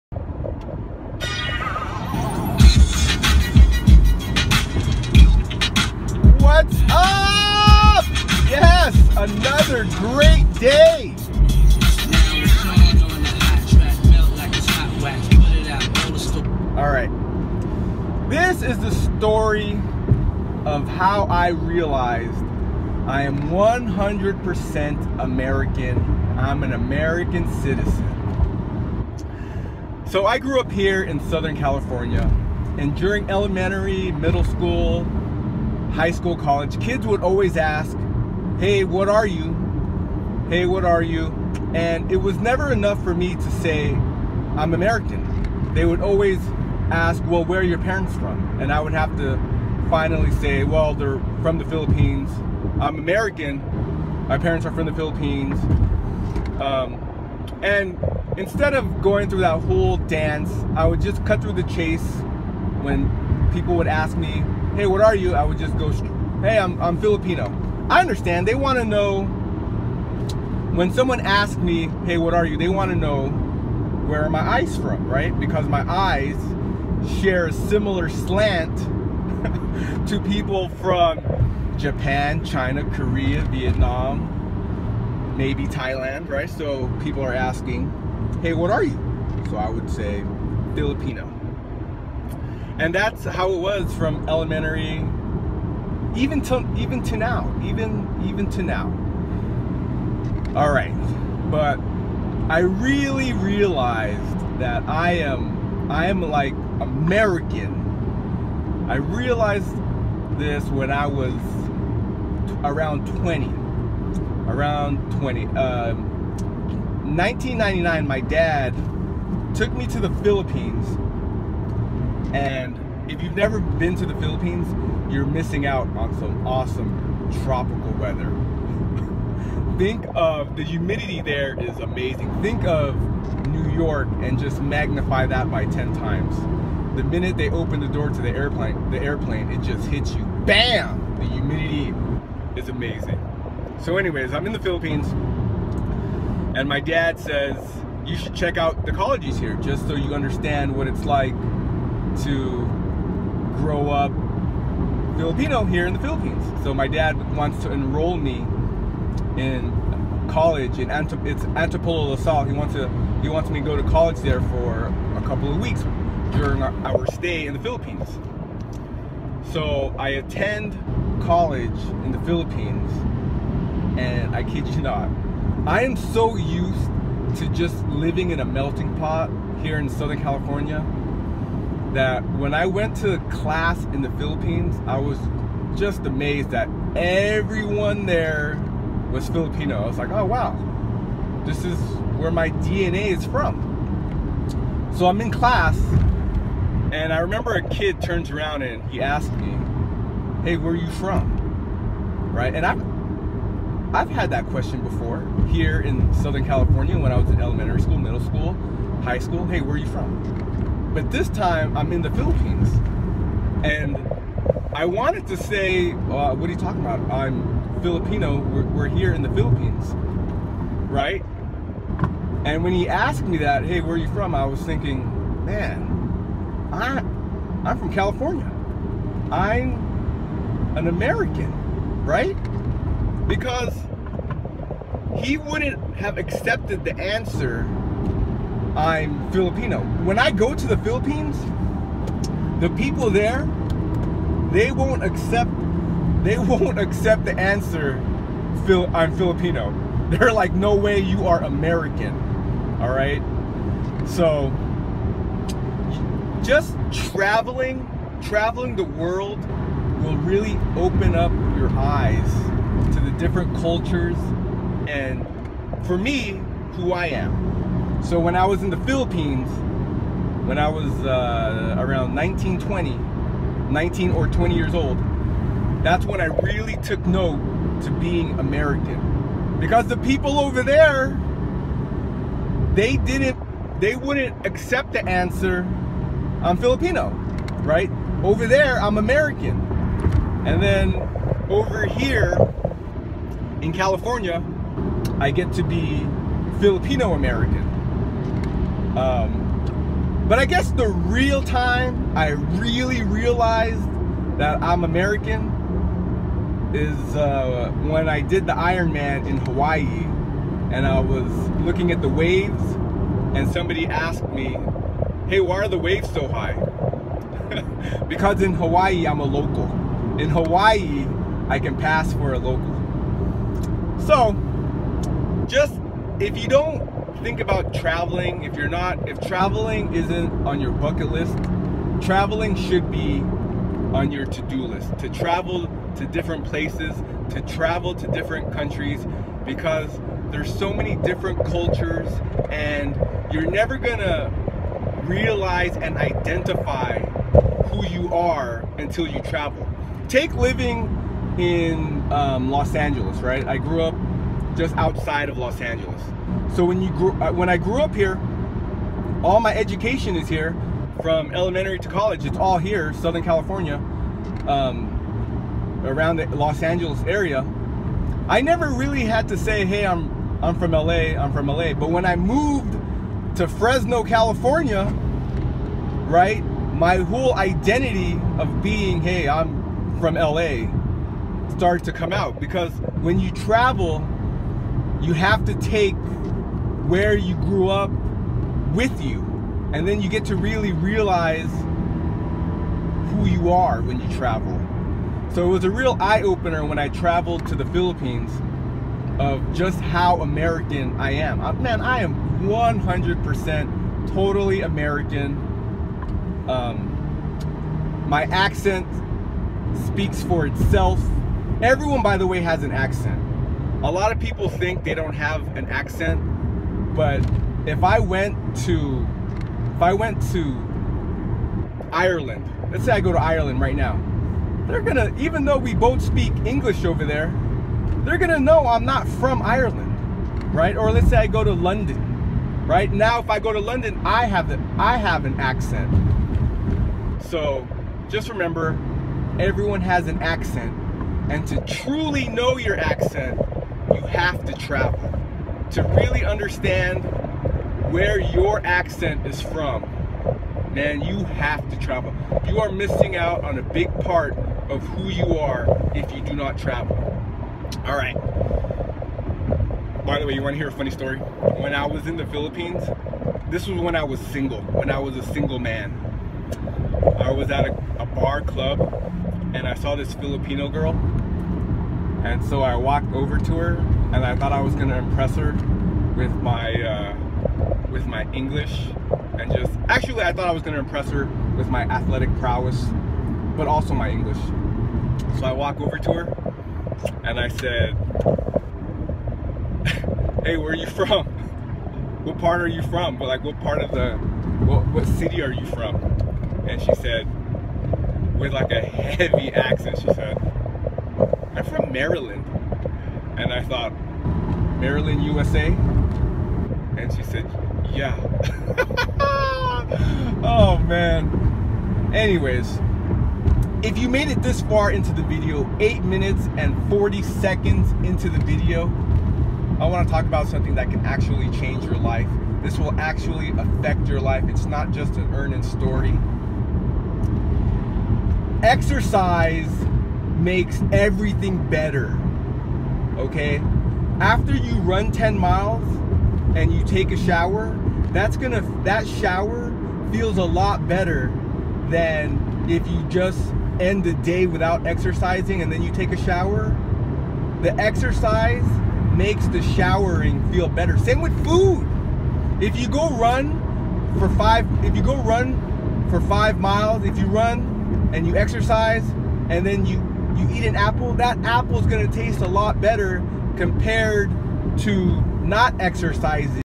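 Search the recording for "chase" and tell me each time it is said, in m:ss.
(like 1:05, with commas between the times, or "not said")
1:01.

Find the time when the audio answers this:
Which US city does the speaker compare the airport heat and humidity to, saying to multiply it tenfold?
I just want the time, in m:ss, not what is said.
2:13.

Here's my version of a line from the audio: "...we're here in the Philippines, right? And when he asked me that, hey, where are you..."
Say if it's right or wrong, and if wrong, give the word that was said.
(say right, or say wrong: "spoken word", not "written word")
right.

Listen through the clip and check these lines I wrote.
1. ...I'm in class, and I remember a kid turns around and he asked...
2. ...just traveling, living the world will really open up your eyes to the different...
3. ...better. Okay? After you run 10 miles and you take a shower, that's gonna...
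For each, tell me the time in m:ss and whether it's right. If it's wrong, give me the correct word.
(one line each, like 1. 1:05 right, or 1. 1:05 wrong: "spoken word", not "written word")
1. 3:15 right
2. 4:16 wrong: "traveling", not "living"
3. 8:51 right.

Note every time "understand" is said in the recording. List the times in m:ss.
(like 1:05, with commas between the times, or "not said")
1:08, 2:30, 7:26.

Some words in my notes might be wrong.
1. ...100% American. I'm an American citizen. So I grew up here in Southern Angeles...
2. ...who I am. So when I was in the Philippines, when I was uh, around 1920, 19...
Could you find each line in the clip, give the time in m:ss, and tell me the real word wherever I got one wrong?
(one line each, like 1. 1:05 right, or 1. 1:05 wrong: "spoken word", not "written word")
1. 0:23 wrong: "California", not "Angeles"
2. 4:26 right.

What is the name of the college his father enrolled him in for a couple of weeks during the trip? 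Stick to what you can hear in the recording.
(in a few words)
Antipolo LaSalle.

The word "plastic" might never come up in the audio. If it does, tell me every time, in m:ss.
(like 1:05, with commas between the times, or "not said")
not said.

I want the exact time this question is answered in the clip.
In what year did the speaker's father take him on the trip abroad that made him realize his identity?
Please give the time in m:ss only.
1:57.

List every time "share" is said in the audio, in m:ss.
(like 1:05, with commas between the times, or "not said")
1:17.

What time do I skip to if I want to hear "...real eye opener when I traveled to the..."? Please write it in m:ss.
6:35.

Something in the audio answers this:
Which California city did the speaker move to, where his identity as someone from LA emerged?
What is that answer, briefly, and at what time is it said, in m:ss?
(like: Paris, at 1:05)
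Fresno, at 6:13.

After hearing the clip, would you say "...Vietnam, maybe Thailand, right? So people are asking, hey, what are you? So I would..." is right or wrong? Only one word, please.
right.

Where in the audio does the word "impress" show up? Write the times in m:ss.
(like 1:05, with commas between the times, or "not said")
7:54, 8:00.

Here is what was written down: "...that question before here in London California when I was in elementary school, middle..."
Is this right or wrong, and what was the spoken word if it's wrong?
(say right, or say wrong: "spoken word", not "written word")
wrong: "Southern", not "London".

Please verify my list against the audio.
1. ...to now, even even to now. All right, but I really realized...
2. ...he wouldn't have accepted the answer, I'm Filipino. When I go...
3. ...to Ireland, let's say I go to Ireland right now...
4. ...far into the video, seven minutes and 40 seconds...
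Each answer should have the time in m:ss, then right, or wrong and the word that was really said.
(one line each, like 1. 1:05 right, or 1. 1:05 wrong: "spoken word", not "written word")
1. 1:37 right
2. 3:55 right
3. 7:00 right
4. 8:34 wrong: "eight", not "seven".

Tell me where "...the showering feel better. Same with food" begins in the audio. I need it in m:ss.
9:09.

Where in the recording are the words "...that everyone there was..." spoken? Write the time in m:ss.
3:06.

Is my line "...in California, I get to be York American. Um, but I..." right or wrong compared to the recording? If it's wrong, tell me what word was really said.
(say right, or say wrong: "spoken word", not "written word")
wrong: "Filipino", not "York".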